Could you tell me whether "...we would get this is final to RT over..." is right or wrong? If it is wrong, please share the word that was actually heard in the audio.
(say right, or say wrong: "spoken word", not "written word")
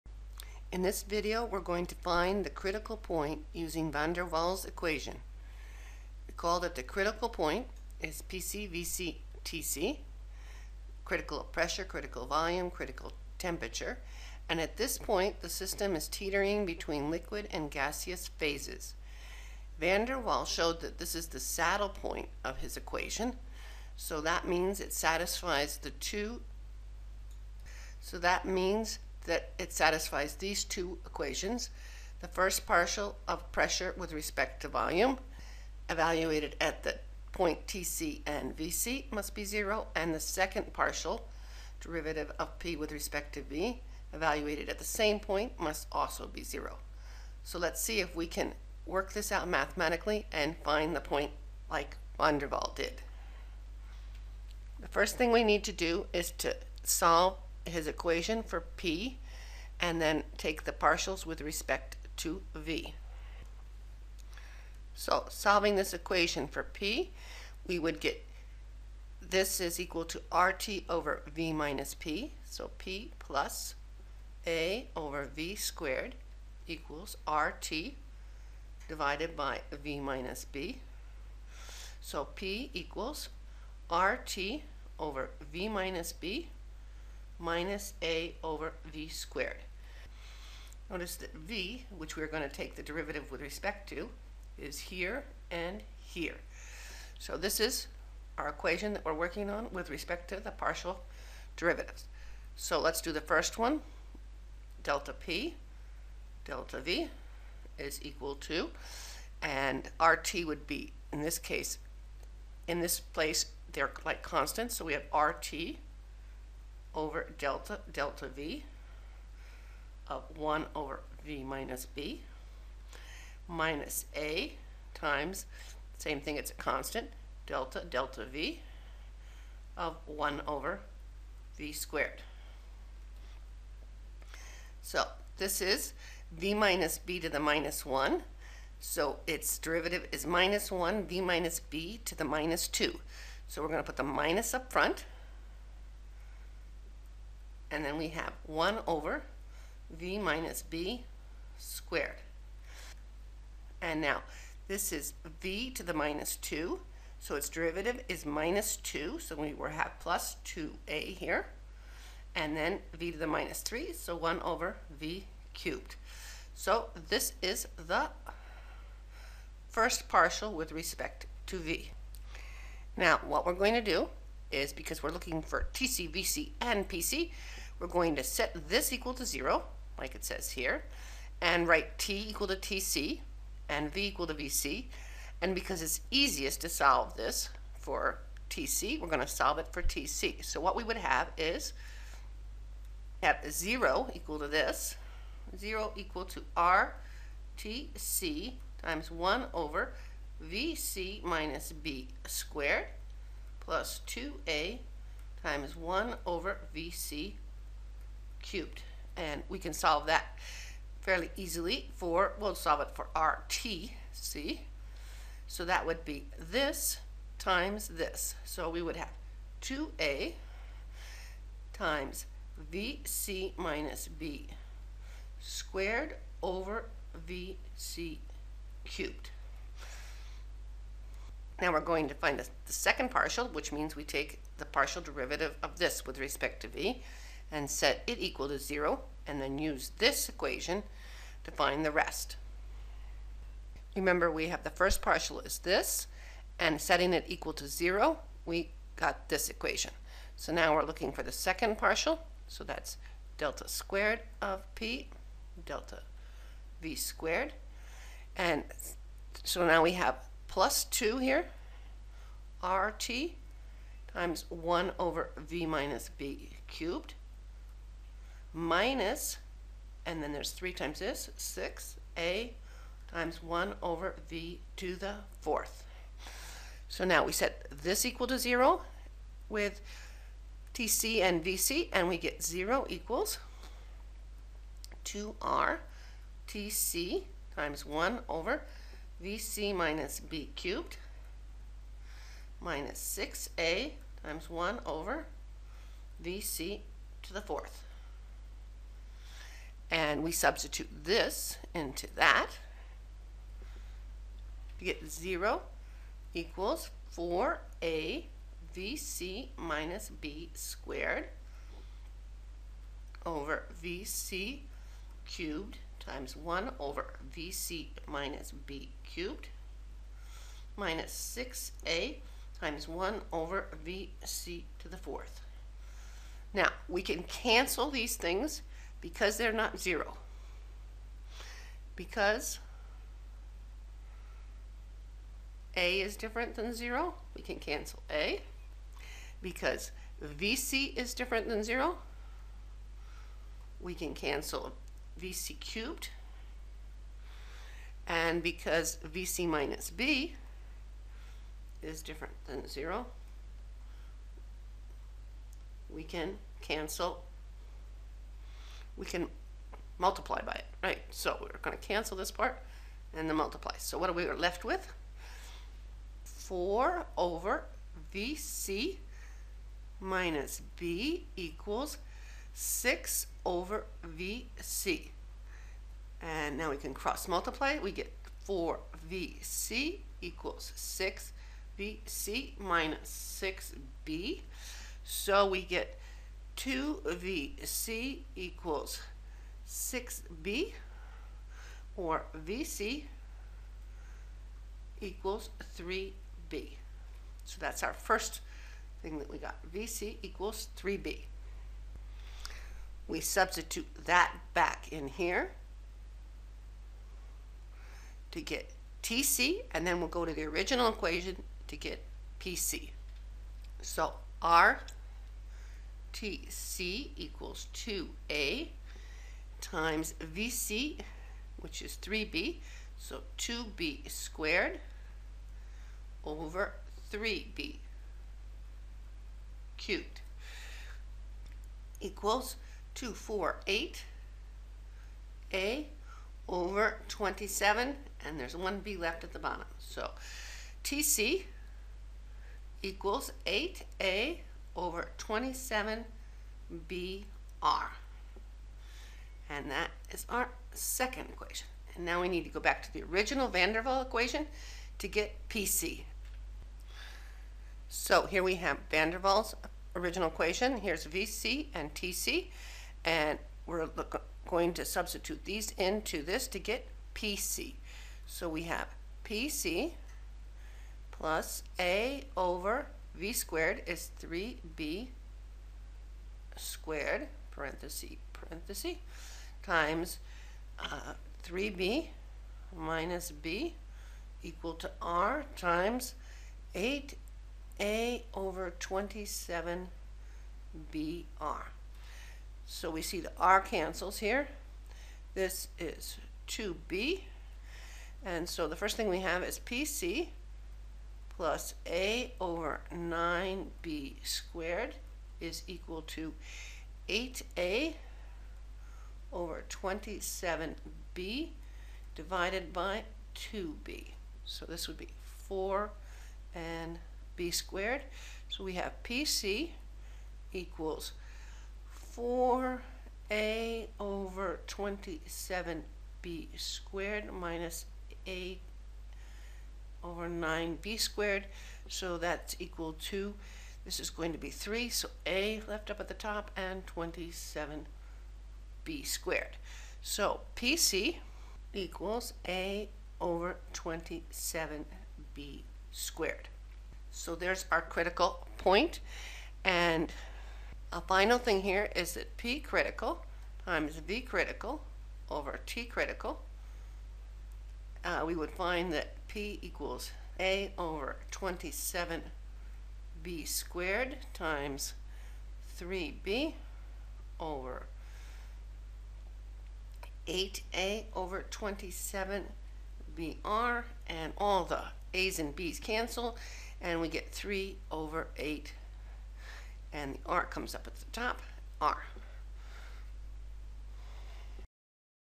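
wrong: "equal", not "final".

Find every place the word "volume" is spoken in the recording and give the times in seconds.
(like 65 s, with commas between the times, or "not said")
12 s, 34 s.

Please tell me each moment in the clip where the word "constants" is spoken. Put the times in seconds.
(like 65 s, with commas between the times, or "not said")
114 s, 126 s.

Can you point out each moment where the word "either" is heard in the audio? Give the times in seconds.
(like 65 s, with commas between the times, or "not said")
not said.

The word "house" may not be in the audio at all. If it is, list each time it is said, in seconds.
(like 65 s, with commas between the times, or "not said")
not said.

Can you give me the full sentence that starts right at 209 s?
And we can solve that fairly easily for, we'll solve it for RT, see?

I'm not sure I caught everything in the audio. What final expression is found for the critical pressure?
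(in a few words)
a/(27b²).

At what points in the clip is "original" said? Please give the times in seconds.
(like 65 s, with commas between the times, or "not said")
410 s, 453 s, 459 s.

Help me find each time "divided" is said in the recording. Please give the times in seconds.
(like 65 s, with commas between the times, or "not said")
78 s, 512 s.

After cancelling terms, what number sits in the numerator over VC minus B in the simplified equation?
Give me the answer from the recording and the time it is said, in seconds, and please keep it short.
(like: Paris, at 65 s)
4, at 366 s.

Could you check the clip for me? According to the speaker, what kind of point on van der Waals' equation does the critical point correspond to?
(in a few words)
saddle point.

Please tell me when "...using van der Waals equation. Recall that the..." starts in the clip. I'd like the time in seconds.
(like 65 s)
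3 s.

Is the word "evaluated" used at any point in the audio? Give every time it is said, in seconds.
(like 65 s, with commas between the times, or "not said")
35 s, 44 s.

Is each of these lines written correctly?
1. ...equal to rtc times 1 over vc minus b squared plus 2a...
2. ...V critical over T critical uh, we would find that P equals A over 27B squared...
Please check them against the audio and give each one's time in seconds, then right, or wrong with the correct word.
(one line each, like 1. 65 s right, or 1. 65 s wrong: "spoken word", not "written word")
1. 195 s right
2. 553 s right.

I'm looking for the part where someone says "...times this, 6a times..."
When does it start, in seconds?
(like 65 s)
270 s.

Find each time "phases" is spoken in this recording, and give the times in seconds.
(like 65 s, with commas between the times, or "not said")
18 s.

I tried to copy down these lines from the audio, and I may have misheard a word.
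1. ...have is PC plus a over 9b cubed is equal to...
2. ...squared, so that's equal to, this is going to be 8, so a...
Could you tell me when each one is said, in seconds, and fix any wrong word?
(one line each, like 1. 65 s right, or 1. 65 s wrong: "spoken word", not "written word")
1. 499 s wrong: "squared", not "cubed"
2. 530 s wrong: "3", not "8".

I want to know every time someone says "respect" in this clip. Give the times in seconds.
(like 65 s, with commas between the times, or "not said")
34 s, 42 s, 61 s, 93 s, 99 s, 170 s, 236 s.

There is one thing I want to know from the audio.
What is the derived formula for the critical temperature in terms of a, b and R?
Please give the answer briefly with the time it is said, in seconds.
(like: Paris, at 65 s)
8a/(27bR), at 440 s.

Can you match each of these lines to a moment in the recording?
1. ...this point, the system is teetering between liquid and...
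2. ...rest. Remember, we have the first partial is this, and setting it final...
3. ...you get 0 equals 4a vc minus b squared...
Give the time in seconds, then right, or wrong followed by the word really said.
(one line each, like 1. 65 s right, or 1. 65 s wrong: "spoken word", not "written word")
1. 14 s right
2. 241 s wrong: "equal", not "final"
3. 304 s right.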